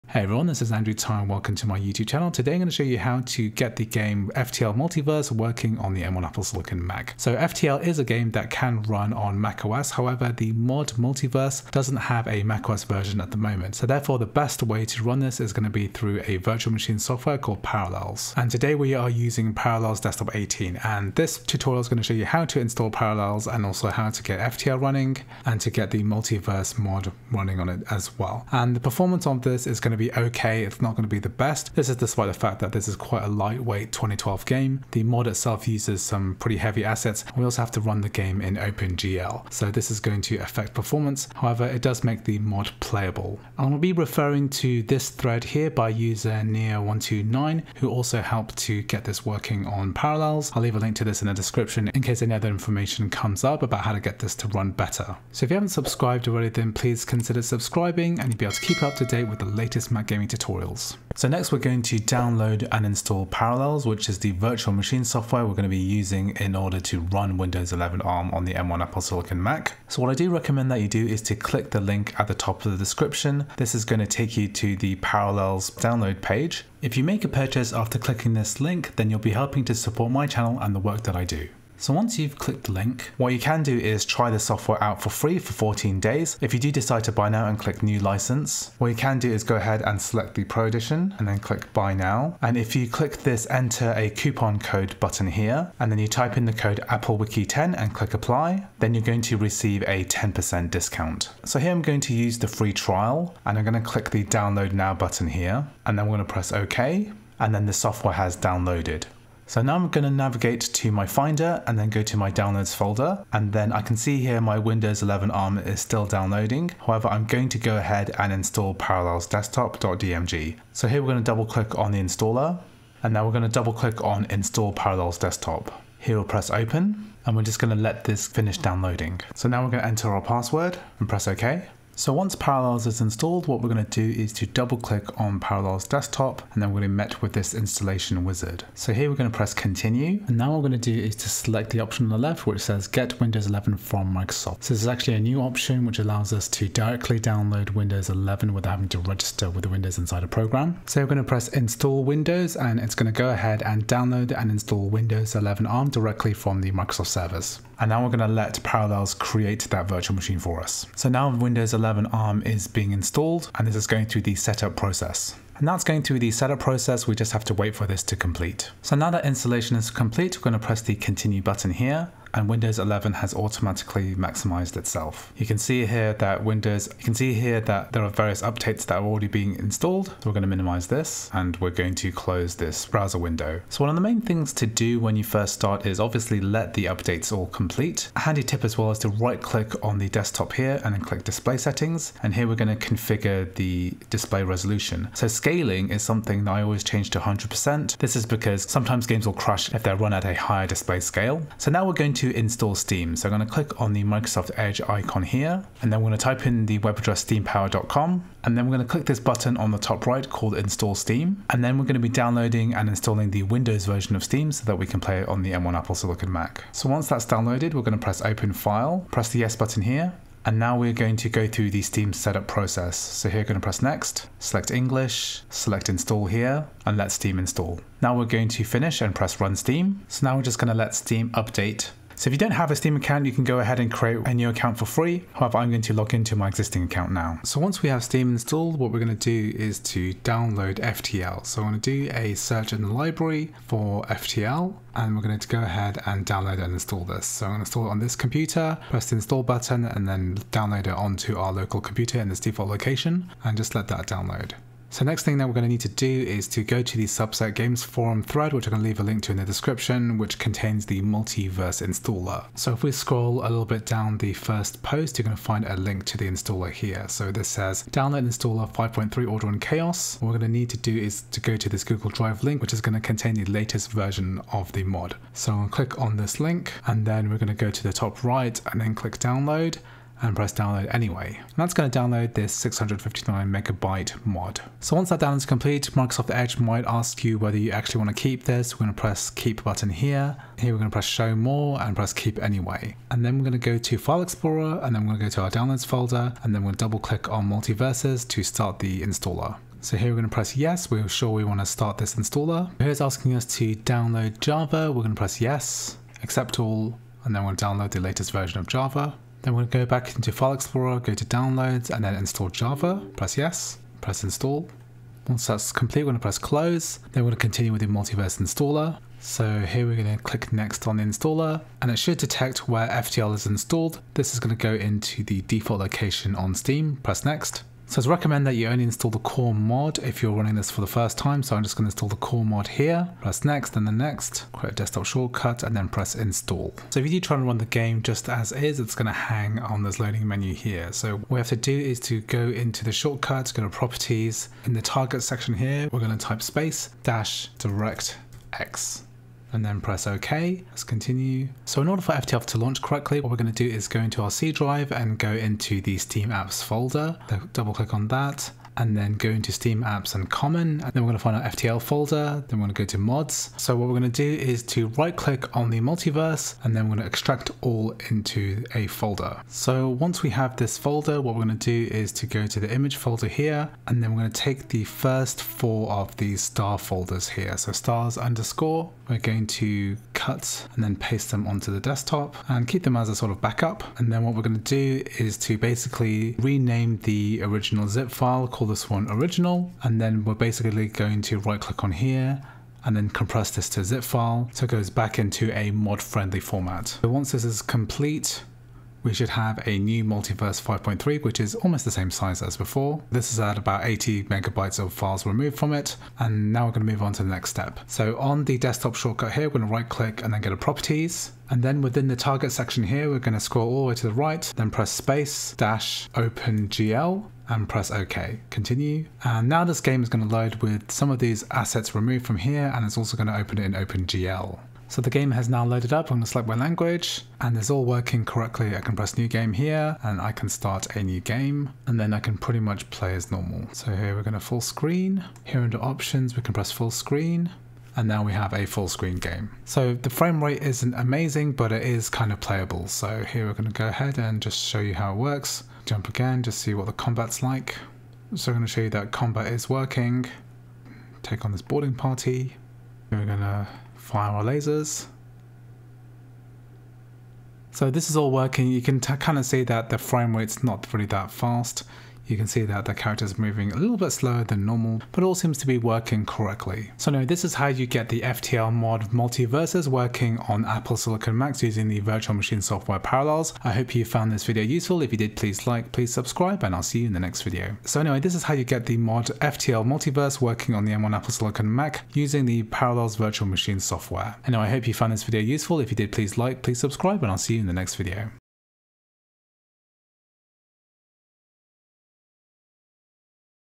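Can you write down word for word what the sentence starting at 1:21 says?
So once you've clicked the link, what you can do is try the software out for free for 14 days.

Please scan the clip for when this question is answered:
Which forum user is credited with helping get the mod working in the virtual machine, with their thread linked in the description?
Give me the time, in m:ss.
0:46.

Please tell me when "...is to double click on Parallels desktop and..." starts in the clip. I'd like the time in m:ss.
2:14.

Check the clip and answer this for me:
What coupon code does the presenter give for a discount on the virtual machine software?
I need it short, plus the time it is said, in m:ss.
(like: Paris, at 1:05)
AppleWiki10, at 1:36.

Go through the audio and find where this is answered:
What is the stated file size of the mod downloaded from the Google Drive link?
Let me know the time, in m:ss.
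4:42.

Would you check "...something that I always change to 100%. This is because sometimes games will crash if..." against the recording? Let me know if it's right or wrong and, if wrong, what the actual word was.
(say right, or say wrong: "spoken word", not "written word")
right.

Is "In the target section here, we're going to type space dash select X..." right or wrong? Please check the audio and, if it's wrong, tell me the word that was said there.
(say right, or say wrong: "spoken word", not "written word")
wrong: "direct", not "select".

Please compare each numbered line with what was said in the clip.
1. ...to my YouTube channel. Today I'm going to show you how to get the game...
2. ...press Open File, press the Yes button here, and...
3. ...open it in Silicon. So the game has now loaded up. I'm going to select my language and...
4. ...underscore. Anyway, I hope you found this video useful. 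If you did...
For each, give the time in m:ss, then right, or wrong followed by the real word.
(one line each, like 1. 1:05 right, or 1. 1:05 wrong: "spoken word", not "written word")
1. 0:01 right
2. 3:38 right
3. 7:03 wrong: "OpenGL", not "Silicon"
4. 8:03 wrong: "software", not "underscore".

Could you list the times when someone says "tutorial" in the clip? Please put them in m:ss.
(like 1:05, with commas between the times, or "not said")
0:21, 1:00.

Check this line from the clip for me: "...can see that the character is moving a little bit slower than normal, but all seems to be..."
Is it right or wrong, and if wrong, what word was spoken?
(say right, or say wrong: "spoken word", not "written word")
right.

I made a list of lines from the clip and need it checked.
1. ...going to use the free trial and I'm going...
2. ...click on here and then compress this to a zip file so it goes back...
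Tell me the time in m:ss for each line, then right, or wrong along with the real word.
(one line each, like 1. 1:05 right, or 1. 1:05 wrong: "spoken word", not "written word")
1. 1:41 right
2. 6:31 right.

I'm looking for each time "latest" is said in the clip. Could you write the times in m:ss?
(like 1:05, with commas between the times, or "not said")
0:59, 4:33, 5:07.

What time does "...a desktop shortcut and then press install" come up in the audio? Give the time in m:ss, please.
5:34.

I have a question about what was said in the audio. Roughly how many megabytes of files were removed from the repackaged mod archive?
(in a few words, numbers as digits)
80 megabytes.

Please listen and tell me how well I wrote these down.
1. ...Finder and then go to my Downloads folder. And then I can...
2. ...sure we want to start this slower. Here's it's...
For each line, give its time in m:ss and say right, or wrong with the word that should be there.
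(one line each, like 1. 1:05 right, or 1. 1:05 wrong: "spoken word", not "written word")
1. 1:51 right
2. 5:01 wrong: "installer", not "slower".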